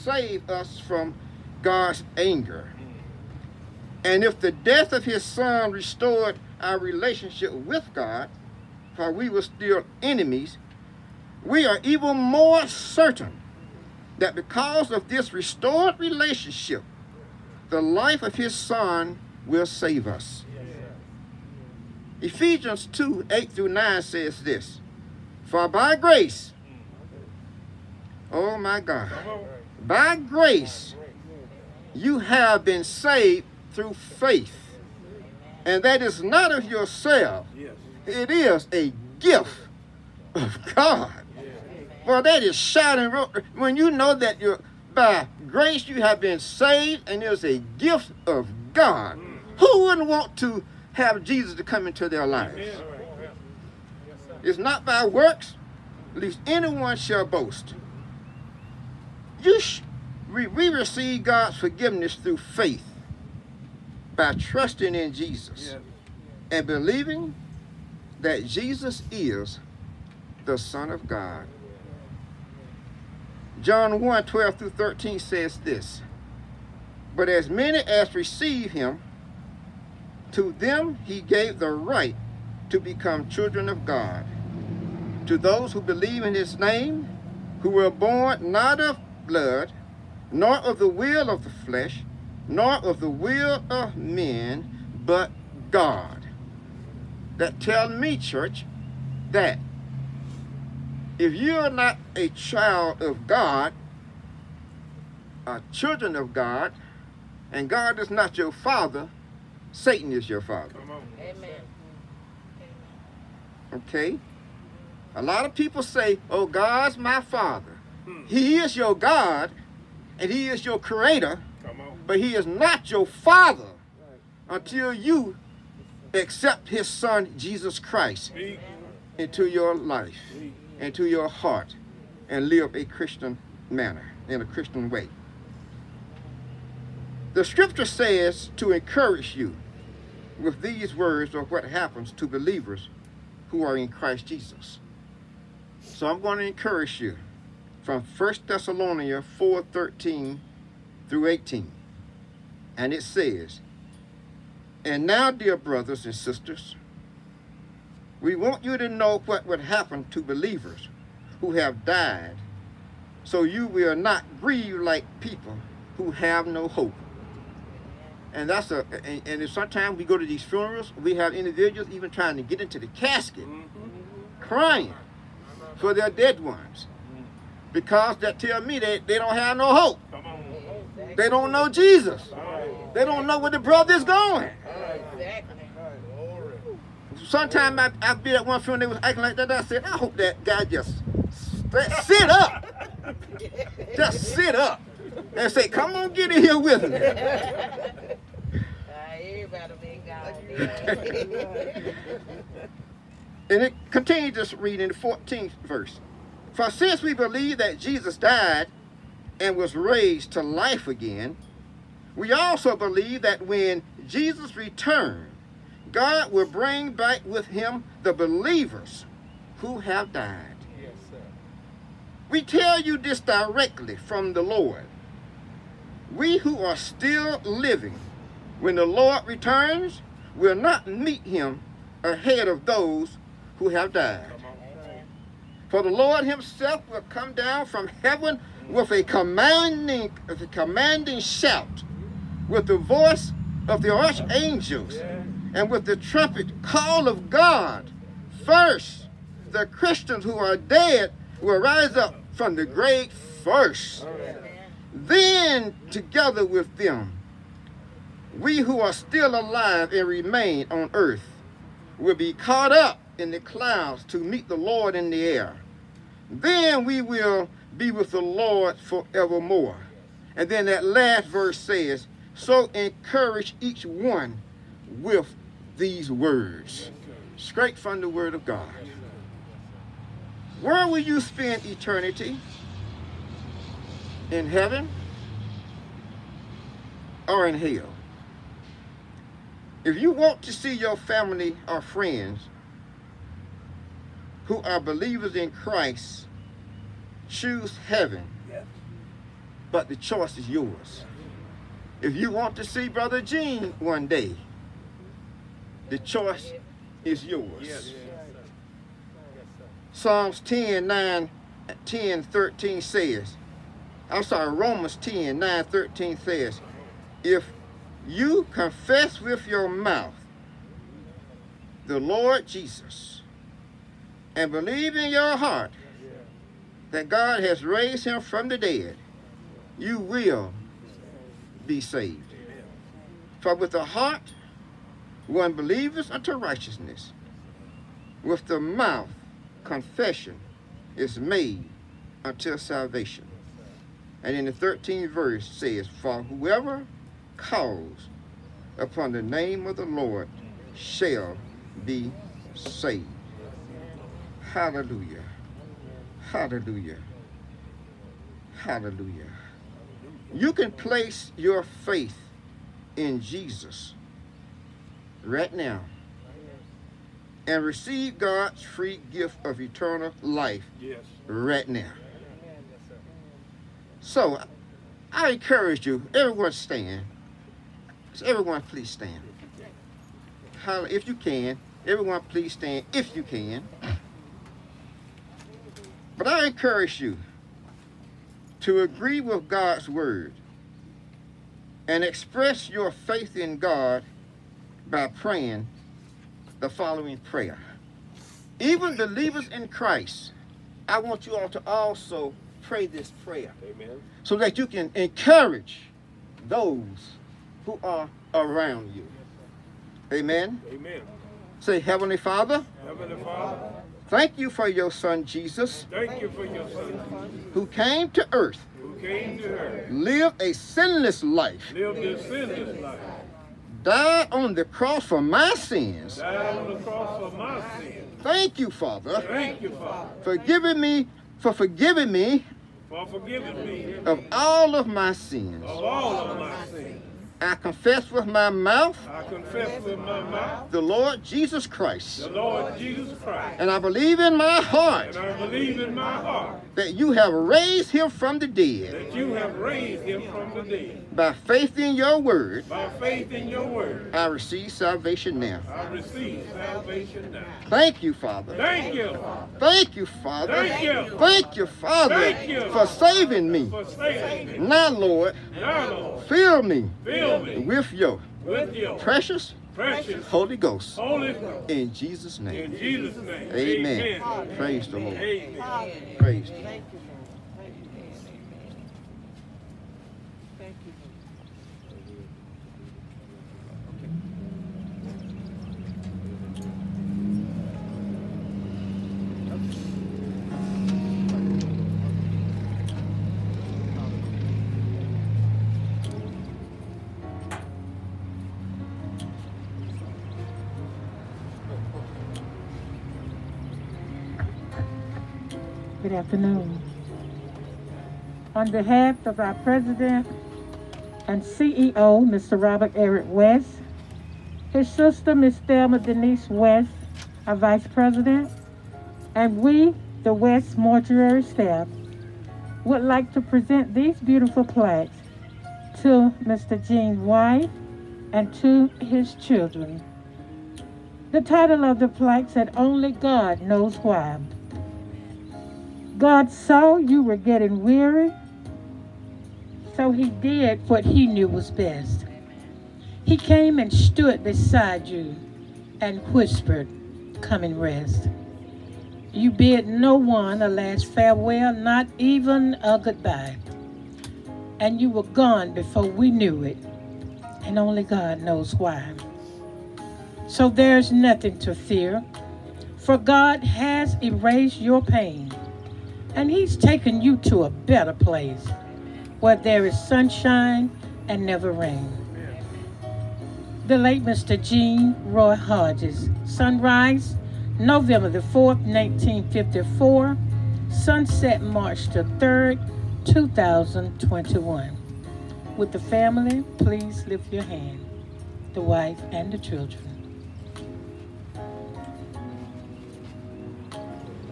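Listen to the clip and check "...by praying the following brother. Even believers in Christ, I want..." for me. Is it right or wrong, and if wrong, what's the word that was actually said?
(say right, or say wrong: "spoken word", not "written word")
wrong: "prayer", not "brother".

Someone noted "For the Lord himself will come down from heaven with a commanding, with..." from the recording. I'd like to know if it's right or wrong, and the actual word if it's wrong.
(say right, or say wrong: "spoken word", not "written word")
right.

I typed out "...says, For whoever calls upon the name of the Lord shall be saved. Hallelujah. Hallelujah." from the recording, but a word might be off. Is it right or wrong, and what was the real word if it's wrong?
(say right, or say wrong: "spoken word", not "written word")
right.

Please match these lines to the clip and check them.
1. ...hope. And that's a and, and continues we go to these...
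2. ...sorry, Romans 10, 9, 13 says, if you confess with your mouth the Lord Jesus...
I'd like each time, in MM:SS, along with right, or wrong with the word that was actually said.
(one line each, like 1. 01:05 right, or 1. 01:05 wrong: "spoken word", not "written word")
1. 02:46 wrong: "sometimes", not "continues"
2. 05:14 right.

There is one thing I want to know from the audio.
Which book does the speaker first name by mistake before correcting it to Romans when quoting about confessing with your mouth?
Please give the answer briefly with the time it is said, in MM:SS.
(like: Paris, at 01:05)
Psalms, at 05:09.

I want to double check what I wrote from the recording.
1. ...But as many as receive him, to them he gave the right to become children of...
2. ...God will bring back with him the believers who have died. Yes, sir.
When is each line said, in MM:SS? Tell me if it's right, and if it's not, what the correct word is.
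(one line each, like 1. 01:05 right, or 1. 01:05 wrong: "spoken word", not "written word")
1. 01:17 right
2. 03:35 right.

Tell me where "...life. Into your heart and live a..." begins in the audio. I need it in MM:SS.
02:09.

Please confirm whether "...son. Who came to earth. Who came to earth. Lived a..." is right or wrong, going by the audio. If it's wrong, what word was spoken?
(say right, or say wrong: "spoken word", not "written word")
right.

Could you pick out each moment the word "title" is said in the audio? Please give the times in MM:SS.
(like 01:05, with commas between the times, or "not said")
08:51.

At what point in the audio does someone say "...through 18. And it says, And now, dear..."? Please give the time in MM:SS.
02:31.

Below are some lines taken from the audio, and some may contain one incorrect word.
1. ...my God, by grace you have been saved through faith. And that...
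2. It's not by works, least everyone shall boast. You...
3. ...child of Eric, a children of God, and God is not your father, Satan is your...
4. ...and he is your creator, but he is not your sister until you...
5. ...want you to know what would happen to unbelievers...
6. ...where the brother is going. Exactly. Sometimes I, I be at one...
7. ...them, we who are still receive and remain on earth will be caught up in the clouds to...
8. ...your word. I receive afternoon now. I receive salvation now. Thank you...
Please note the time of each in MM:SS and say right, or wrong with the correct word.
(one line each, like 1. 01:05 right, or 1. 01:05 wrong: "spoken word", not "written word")
1. 00:28 right
2. 00:54 wrong: "anyone", not "everyone"
3. 01:42 wrong: "God", not "Eric"
4. 02:00 wrong: "father", not "sister"
5. 02:38 wrong: "believers", not "unbelievers"
6. 03:03 right
7. 04:16 wrong: "alive", not "receive"
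8. 07:33 wrong: "salvation", not "afternoon".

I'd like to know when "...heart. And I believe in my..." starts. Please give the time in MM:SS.
07:24.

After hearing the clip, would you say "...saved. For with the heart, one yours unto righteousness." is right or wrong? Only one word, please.
wrong.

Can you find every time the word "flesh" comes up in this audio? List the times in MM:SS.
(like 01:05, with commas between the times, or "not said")
01:31.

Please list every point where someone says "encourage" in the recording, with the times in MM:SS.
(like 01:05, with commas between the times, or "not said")
02:18, 02:26, 04:32, 06:15, 06:26, 06:44.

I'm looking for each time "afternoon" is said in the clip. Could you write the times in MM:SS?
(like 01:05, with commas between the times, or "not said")
08:26.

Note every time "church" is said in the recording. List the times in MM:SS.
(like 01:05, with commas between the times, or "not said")
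01:38.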